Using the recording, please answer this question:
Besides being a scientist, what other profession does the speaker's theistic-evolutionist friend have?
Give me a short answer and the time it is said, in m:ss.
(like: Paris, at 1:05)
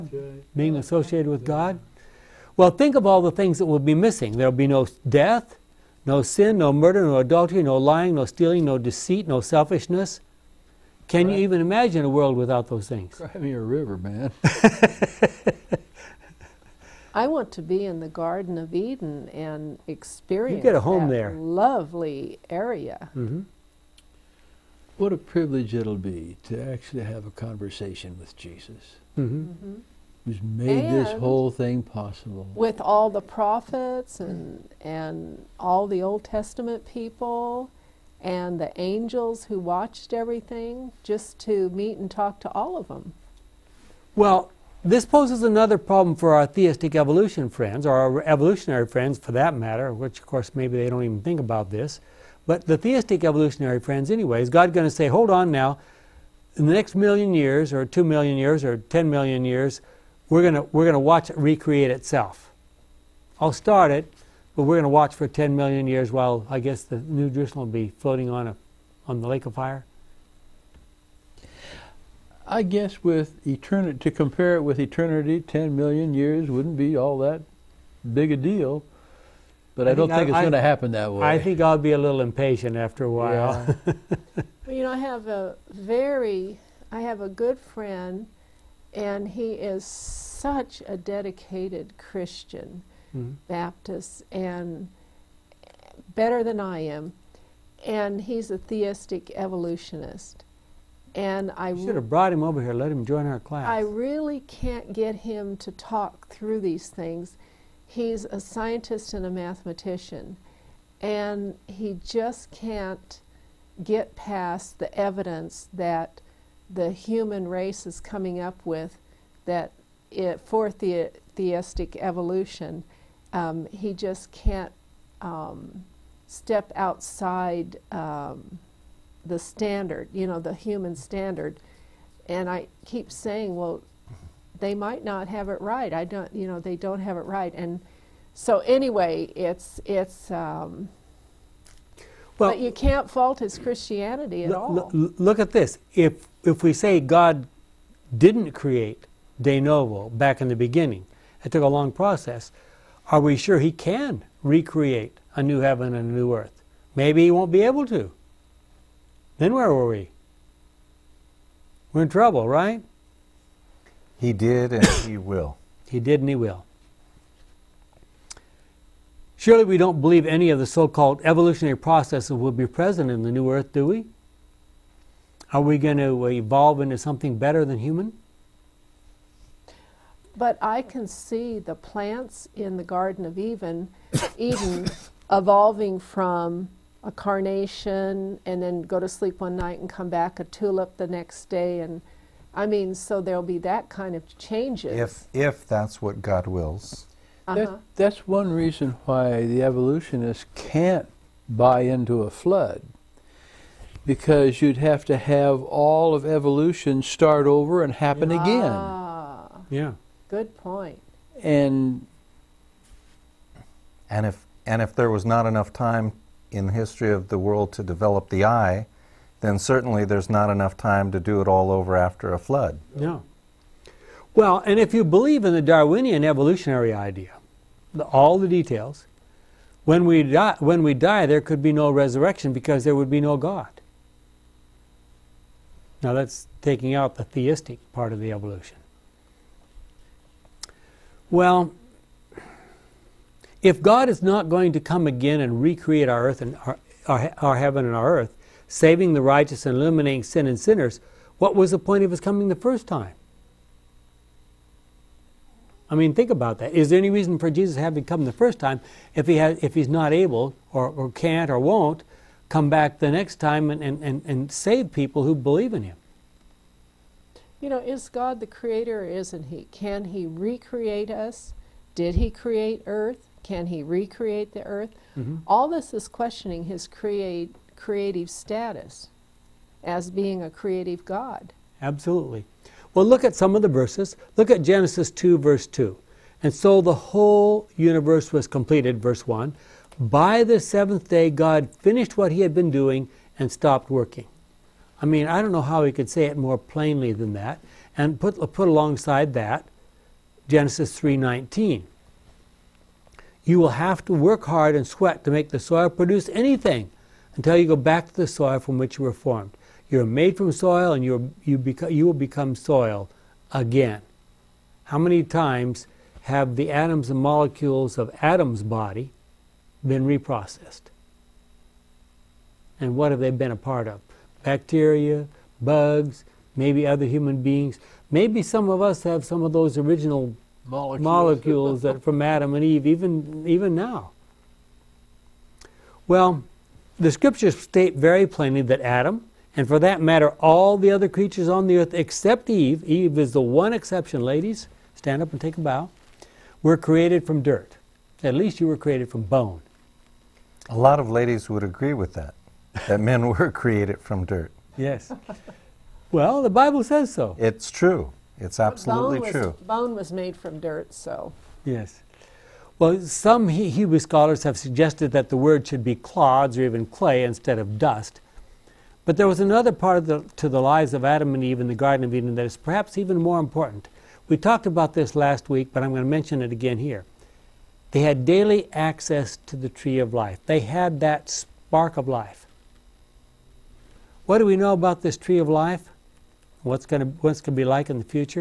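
mathematician, at 1:49.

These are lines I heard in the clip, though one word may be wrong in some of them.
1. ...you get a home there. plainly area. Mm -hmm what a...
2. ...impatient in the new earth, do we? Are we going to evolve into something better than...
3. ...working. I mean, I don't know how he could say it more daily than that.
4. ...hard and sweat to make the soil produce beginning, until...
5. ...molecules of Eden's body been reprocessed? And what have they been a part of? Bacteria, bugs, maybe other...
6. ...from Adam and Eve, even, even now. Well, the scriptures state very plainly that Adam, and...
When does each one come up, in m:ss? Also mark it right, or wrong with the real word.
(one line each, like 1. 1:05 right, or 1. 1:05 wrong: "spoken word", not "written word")
1. 0:20 wrong: "lovely", not "plainly"
2. 2:52 wrong: "present", not "impatient"
3. 4:53 wrong: "plainly", not "daily"
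4. 5:04 wrong: "anything", not "beginning"
5. 5:17 wrong: "Adam", not "Eden"
6. 5:32 right.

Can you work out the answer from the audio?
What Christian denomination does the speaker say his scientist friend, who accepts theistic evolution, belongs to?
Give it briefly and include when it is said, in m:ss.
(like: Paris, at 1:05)
Baptist, at 1:33.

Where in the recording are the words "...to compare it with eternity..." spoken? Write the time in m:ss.
1:13.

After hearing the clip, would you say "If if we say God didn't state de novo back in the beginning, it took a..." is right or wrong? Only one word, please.
wrong.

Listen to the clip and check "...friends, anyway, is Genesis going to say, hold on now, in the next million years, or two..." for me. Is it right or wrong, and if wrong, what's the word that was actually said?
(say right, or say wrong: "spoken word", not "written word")
wrong: "God", not "Genesis".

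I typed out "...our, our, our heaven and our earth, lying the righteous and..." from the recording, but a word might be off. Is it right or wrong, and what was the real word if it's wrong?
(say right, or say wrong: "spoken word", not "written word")
wrong: "saving", not "lying".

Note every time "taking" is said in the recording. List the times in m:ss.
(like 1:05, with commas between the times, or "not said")
3:56.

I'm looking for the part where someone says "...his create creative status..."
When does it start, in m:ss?
4:36.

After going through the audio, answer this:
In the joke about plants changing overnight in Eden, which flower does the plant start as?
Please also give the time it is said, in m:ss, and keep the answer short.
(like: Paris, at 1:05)
carnation, at 3:07.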